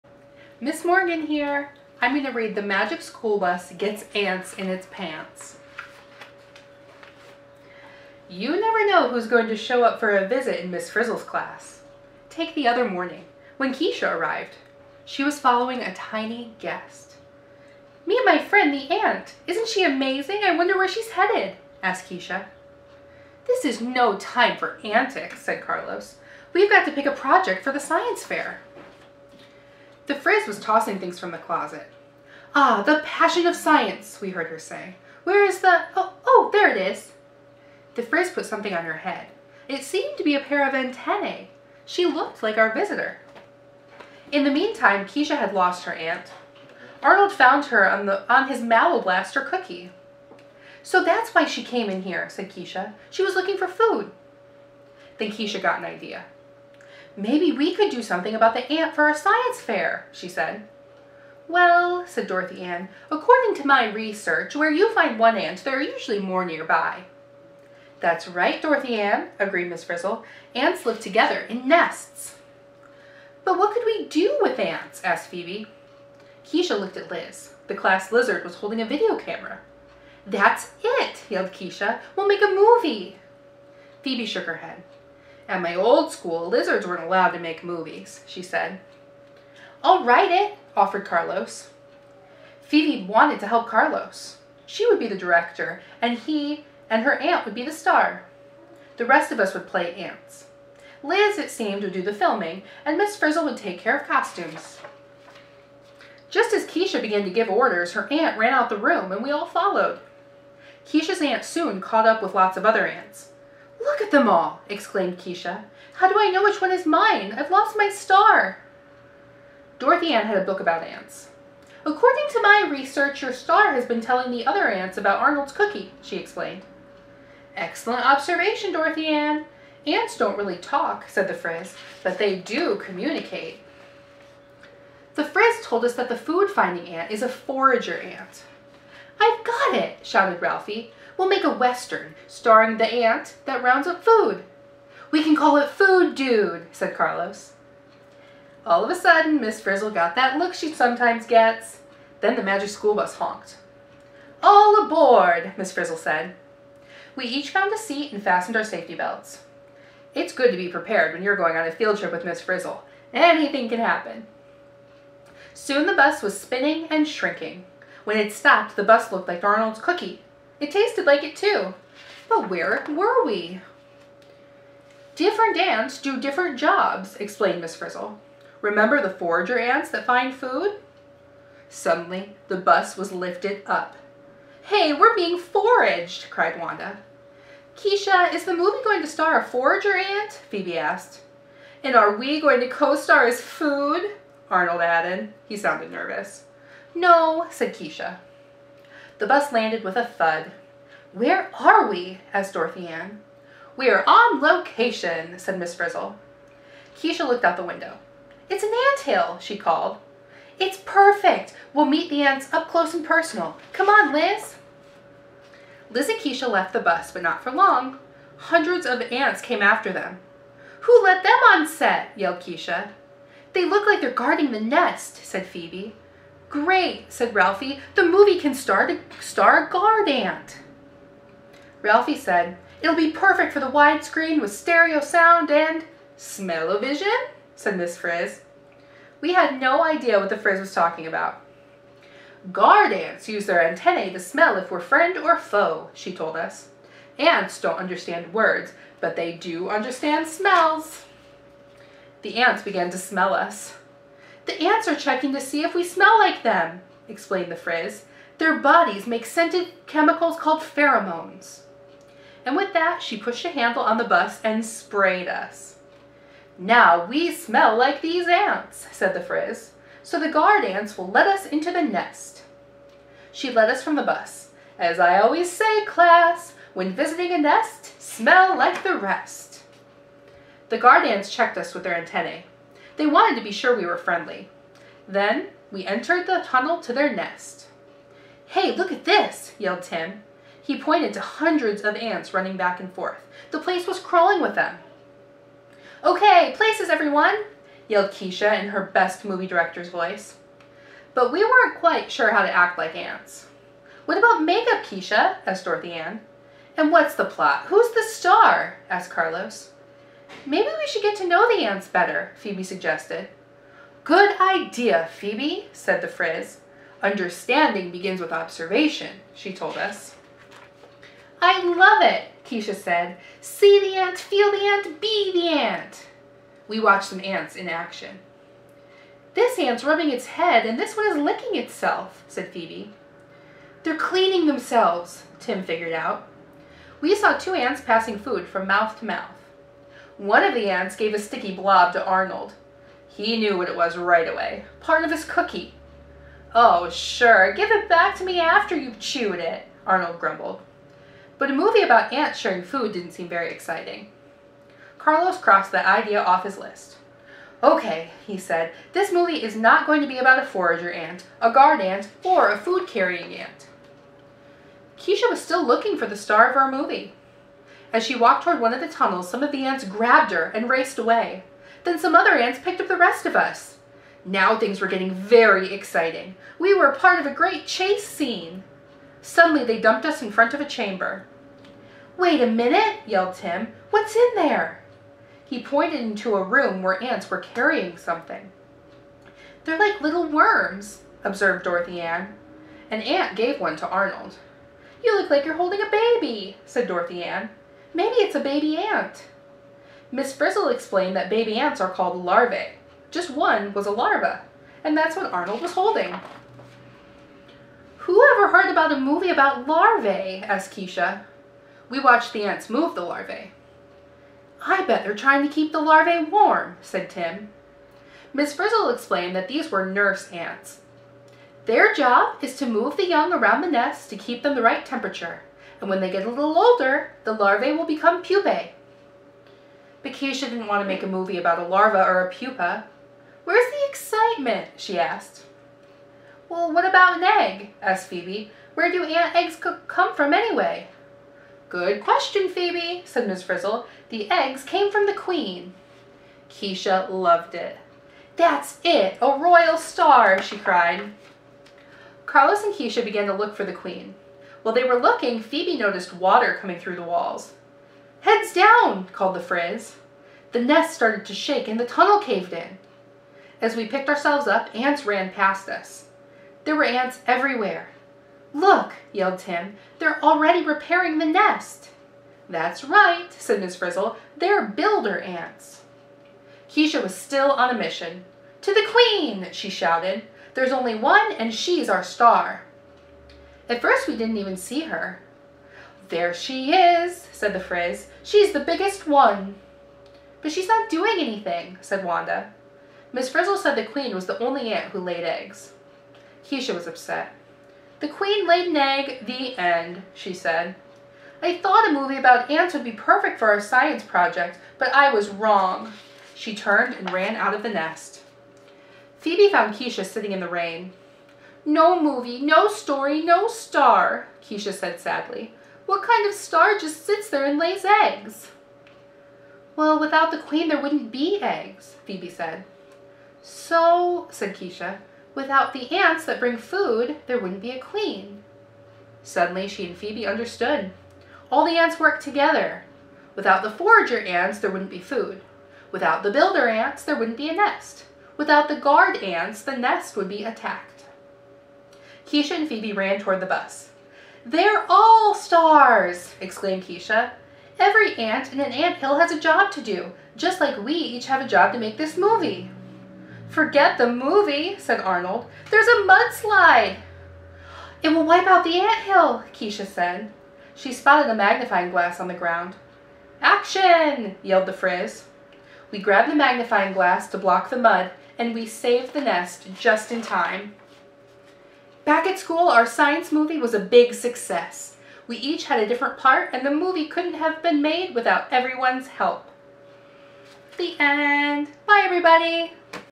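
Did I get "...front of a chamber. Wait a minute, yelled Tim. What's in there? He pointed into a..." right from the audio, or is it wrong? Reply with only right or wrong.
right.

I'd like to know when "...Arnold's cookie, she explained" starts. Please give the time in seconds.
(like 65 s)
125 s.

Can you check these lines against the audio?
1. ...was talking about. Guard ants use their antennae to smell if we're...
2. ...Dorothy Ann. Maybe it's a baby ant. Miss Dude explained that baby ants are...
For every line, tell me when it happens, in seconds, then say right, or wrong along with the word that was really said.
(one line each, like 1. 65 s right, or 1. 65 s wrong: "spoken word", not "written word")
1. 240 s right
2. 396 s wrong: "Frizzle", not "Dude".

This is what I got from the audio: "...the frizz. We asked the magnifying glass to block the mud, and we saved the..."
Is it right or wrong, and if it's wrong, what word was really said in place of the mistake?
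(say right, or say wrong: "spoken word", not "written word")
wrong: "grabbed", not "asked".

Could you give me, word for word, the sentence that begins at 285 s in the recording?
Then we entered the tunnel to their nest.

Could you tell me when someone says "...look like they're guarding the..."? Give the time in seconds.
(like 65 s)
223 s.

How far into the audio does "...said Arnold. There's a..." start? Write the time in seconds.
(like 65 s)
554 s.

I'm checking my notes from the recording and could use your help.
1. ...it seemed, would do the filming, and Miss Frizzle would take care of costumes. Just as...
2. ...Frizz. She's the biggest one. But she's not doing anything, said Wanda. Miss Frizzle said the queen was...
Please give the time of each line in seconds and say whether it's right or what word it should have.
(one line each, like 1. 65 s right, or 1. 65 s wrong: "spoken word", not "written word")
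1. 101 s right
2. 487 s right.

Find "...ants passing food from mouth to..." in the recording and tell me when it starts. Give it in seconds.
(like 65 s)
337 s.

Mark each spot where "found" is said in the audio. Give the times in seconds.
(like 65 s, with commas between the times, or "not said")
47 s, 157 s, 509 s.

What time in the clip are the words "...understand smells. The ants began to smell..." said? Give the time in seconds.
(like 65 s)
249 s.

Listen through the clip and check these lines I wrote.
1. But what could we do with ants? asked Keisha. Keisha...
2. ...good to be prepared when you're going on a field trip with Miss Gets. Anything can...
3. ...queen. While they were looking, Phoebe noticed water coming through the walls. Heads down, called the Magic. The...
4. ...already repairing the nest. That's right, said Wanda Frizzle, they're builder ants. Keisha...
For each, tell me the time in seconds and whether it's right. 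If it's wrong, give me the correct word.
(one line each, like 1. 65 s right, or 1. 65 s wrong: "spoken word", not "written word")
1. 73 s wrong: "Phoebe", not "Keisha"
2. 160 s wrong: "Frizzle", not "Gets"
3. 453 s wrong: "Frizz", not "Magic"
4. 470 s wrong: "Miss", not "Wanda".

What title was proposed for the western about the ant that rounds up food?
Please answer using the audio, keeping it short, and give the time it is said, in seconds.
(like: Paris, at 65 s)
Food Dude, at 145 s.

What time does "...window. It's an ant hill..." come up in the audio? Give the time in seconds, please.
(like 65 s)
207 s.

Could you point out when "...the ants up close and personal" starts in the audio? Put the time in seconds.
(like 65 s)
212 s.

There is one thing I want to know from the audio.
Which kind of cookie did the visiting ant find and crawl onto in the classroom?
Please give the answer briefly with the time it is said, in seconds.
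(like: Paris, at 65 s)
Mallow blaster cookie, at 48 s.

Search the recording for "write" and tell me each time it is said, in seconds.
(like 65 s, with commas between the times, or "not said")
90 s.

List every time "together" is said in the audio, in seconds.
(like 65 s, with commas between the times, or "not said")
71 s, 532 s.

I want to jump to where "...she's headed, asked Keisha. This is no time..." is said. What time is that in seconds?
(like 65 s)
20 s.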